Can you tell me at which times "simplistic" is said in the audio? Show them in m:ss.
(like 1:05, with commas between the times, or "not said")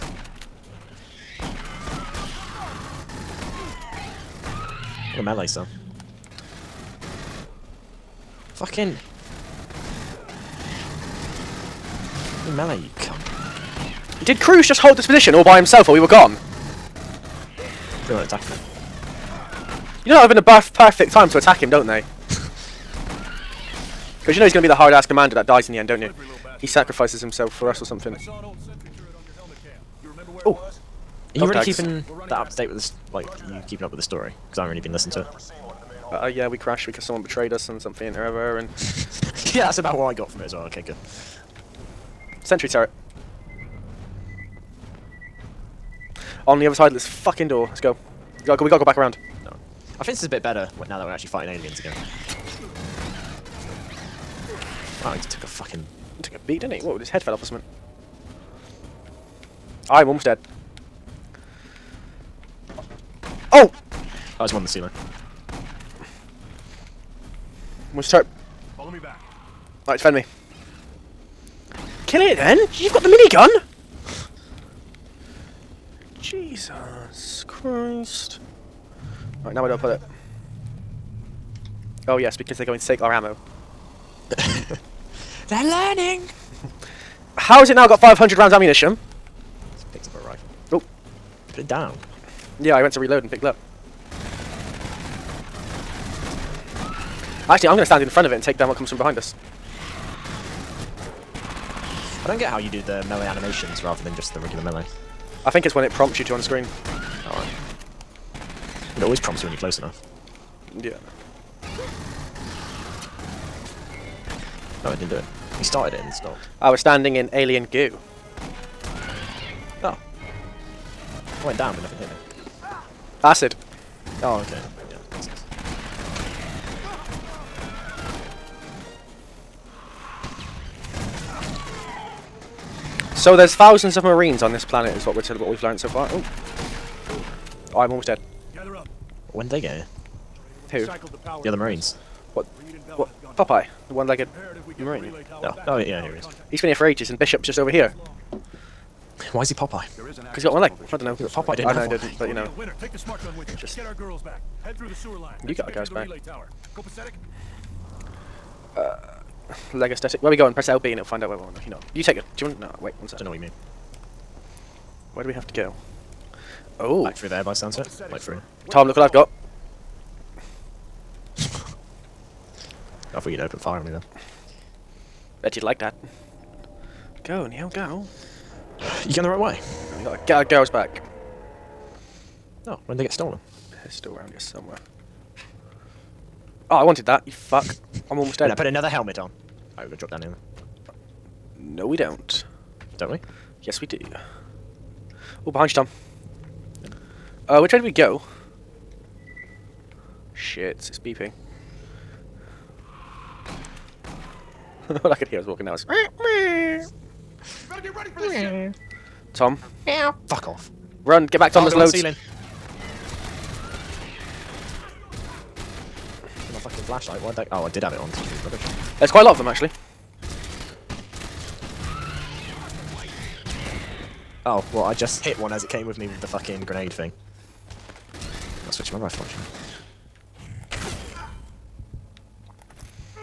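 not said.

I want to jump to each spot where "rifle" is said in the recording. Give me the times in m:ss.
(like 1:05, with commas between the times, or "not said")
1:30, 3:48.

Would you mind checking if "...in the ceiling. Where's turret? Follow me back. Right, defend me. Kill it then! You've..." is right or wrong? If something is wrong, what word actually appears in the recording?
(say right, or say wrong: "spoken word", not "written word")
right.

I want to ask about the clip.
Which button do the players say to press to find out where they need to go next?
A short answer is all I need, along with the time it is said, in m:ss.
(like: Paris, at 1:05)
LB, at 2:40.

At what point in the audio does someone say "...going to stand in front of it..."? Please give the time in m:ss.
1:37.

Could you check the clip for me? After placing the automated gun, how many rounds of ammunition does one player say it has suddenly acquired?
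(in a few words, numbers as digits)
500.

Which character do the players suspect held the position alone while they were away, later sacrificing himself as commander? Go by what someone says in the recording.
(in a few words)
Cruz.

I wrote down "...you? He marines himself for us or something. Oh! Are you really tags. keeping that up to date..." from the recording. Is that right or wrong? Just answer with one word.
wrong.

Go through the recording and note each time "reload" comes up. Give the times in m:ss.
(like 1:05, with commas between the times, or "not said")
1:32.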